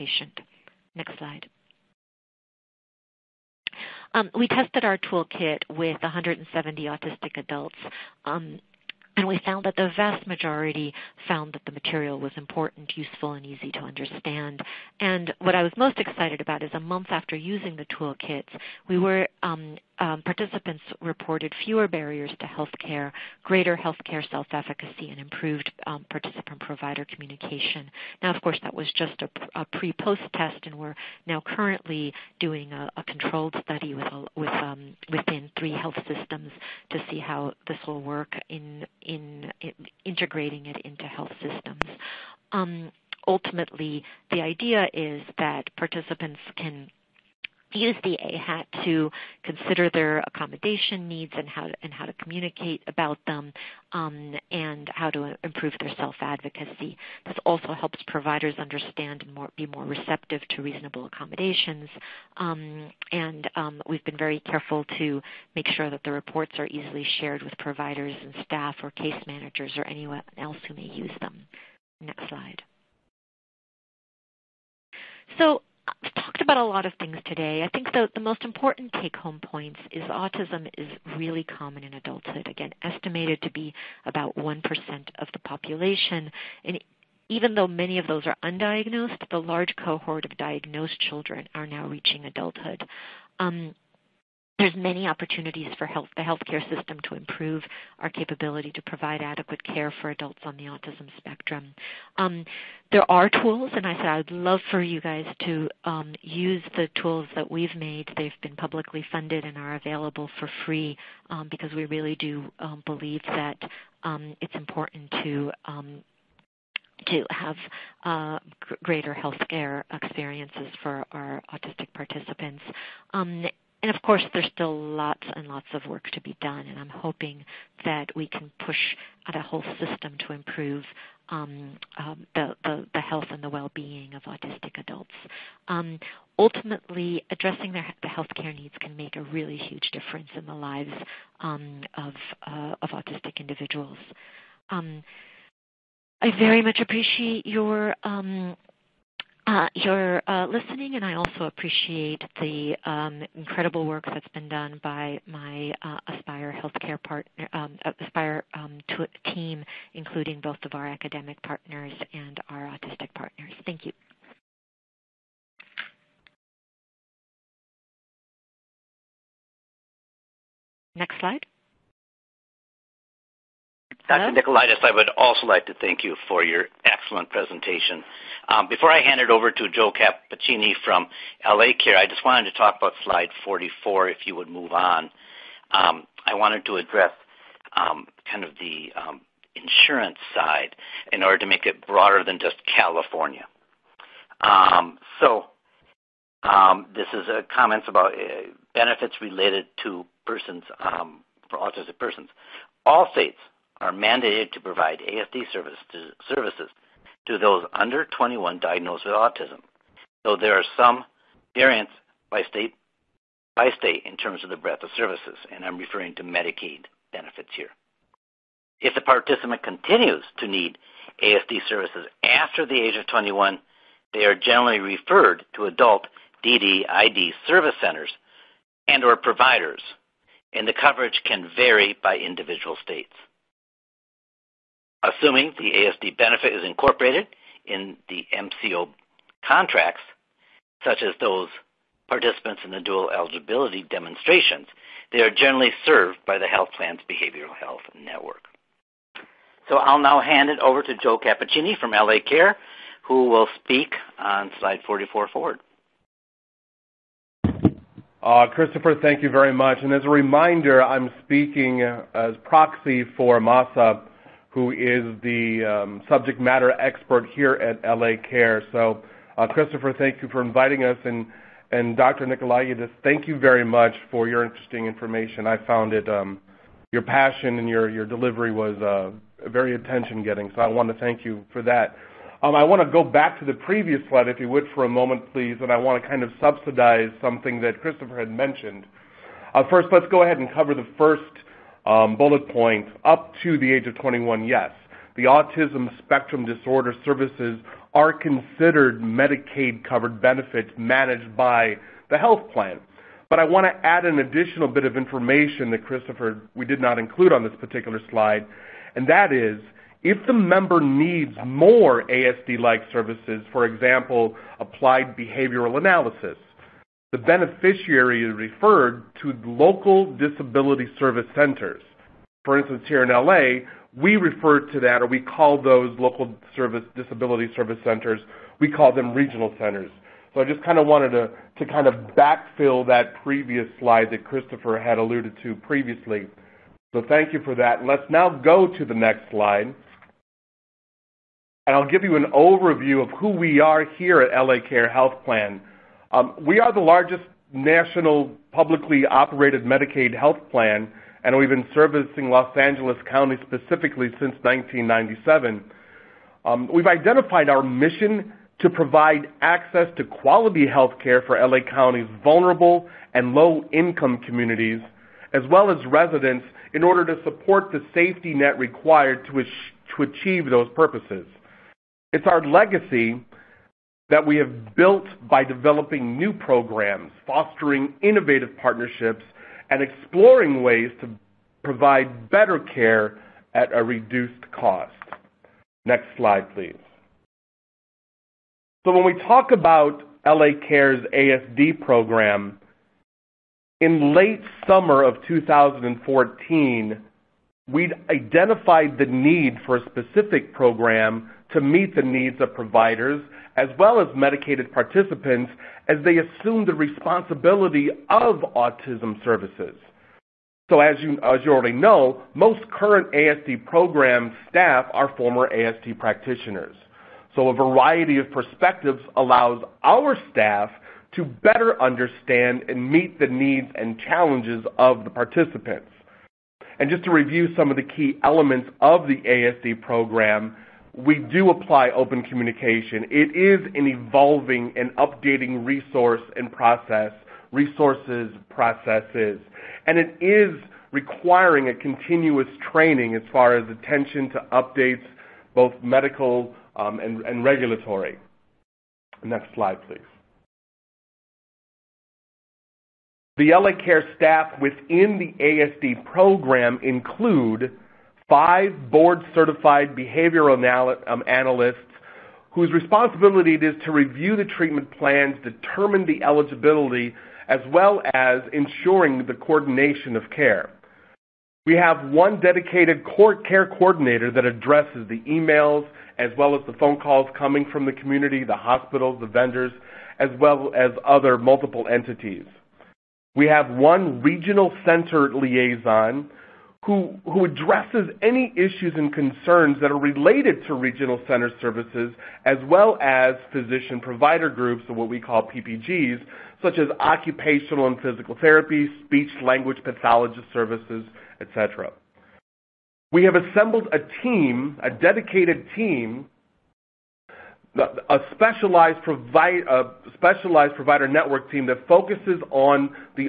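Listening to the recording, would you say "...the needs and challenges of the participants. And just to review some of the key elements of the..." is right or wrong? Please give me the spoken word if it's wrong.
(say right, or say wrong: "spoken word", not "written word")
right.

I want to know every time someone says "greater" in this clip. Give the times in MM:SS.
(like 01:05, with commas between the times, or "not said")
00:23, 01:58.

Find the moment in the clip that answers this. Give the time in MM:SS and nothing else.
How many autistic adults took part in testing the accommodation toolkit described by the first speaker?
00:06.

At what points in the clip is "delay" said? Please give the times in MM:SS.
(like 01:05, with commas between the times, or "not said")
not said.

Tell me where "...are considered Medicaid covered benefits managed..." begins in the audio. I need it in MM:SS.
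04:57.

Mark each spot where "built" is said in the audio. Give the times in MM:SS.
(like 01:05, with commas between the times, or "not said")
06:14.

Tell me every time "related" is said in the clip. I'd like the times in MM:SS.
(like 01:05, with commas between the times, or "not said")
03:19, 08:09.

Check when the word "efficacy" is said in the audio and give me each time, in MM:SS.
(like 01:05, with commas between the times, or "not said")
00:24.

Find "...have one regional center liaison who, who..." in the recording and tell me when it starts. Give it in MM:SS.
08:03.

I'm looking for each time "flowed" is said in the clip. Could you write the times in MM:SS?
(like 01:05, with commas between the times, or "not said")
not said.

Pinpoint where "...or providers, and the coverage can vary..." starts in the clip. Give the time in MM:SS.
03:49.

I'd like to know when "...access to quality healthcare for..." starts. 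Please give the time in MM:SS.
05:59.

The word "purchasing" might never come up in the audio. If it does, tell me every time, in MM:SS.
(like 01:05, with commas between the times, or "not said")
not said.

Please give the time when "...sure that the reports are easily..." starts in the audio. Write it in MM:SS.
01:05.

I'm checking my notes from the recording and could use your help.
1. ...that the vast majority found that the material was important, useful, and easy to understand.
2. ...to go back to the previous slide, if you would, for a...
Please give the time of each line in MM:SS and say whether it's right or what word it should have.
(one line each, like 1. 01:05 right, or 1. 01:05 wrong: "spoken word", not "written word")
1. 00:09 right
2. 04:42 right.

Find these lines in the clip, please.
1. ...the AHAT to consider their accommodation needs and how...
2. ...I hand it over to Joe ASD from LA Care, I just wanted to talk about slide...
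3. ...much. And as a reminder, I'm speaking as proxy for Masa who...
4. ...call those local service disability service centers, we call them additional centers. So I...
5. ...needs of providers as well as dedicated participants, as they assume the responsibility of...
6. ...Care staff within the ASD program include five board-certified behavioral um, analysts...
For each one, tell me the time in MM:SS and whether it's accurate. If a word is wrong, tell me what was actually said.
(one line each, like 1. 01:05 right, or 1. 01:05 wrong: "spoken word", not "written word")
1. 00:48 right
2. 02:58 wrong: "Cappuccini", not "ASD"
3. 04:19 right
4. 05:25 wrong: "regional", not "additional"
5. 06:42 wrong: "medicated", not "dedicated"
6. 07:33 right.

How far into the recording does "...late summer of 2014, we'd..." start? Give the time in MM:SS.
06:34.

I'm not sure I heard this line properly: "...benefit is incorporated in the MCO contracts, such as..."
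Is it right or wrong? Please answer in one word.
right.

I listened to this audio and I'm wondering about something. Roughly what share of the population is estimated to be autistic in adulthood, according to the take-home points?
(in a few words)
1%.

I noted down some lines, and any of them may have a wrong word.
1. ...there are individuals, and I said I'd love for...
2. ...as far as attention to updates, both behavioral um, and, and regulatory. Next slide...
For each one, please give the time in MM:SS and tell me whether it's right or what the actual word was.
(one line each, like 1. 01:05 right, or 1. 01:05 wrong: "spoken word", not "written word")
1. 01:42 wrong: "tools", not "individuals"
2. 07:23 wrong: "medical", not "behavioral".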